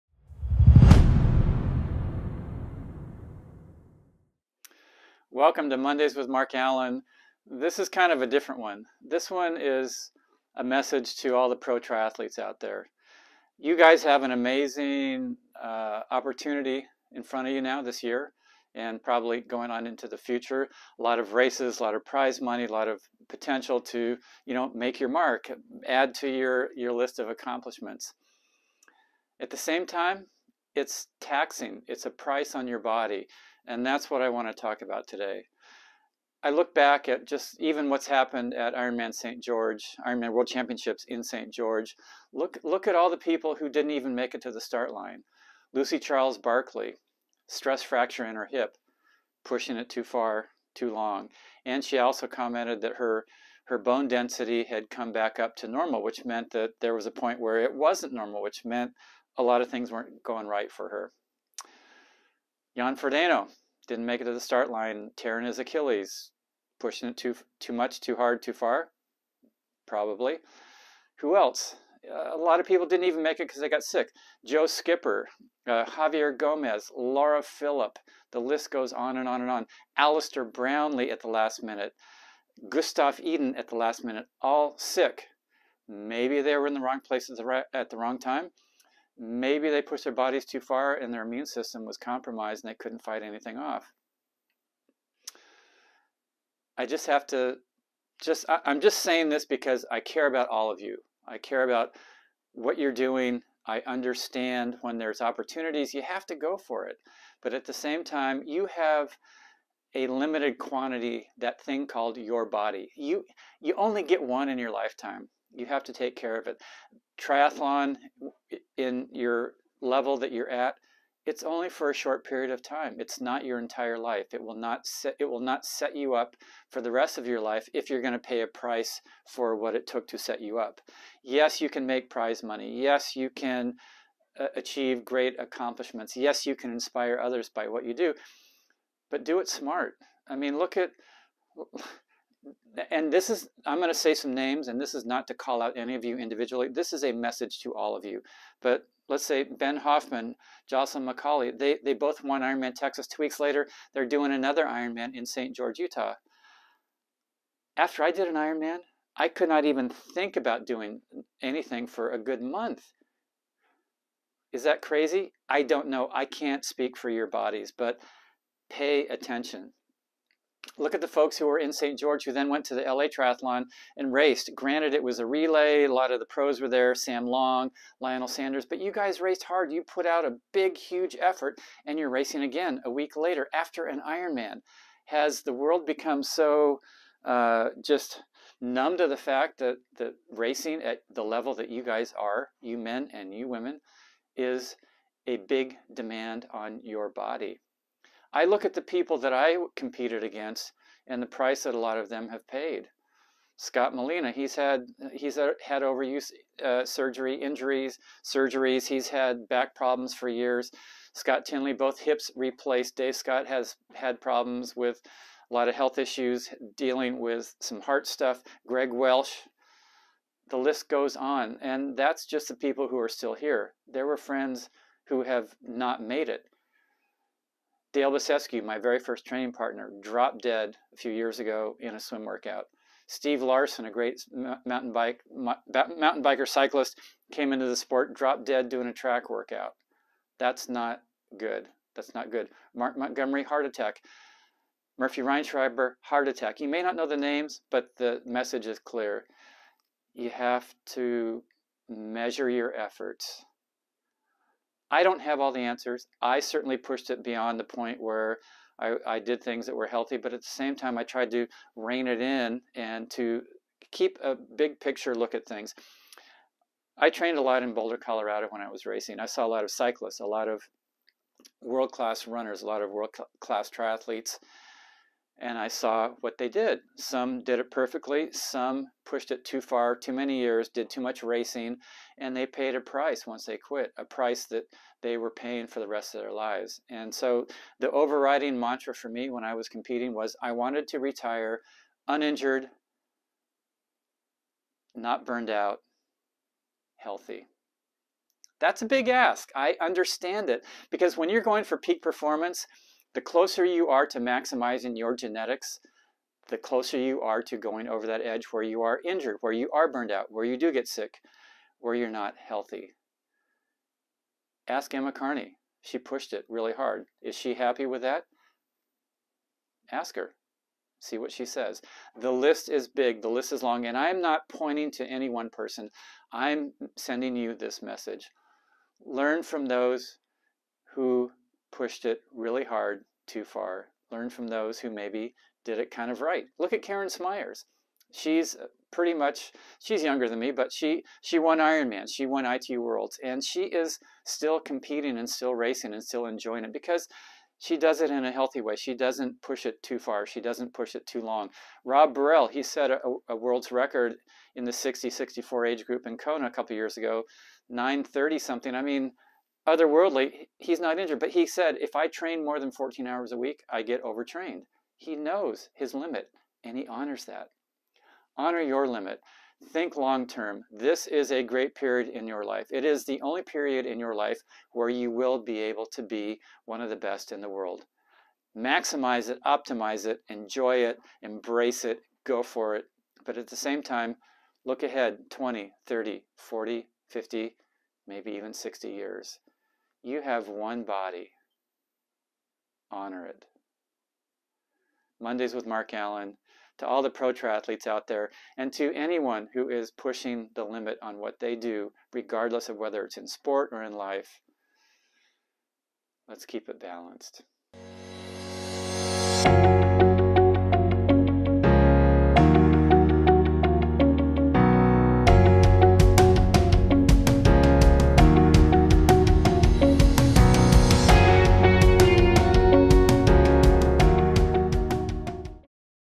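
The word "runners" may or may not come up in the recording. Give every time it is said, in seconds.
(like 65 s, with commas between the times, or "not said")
272 s.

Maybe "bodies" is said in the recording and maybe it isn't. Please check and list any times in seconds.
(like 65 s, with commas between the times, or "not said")
90 s, 167 s.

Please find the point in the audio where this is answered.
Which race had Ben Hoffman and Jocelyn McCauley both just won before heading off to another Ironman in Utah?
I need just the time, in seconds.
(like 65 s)
152 s.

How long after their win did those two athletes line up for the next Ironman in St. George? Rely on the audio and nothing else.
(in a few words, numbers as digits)
2 weeks.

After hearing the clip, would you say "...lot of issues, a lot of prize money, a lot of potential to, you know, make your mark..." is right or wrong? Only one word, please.
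wrong.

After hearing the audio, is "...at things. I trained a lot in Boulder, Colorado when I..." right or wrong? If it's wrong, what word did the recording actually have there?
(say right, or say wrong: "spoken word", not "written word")
right.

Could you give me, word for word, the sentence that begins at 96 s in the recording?
I just have to just I, am just saying this because I care about all of you.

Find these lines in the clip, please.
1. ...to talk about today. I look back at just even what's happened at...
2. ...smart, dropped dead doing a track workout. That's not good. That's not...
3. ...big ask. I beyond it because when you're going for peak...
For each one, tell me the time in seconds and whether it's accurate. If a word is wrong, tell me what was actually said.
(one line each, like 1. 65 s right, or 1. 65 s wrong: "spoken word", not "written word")
1. 34 s right
2. 237 s wrong: "sport", not "smart"
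3. 298 s wrong: "understand", not "beyond".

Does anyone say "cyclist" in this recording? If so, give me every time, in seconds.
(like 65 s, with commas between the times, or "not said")
236 s, 269 s.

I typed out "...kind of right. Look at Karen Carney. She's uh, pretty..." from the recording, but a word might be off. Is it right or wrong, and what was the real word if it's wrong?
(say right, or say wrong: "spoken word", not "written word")
wrong: "Smyers", not "Carney".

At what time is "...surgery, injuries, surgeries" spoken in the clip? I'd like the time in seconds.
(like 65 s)
206 s.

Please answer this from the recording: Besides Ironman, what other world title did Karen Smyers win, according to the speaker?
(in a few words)
ITU Worlds.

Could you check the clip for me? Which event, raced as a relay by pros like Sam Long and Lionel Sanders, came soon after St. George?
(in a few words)
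LA Triathlon.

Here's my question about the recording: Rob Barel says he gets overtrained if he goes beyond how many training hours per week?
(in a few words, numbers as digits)
14 hours.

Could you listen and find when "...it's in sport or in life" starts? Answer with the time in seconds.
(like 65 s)
403 s.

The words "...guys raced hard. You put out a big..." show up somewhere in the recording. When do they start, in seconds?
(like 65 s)
178 s.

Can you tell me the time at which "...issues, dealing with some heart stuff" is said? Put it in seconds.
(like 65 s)
215 s.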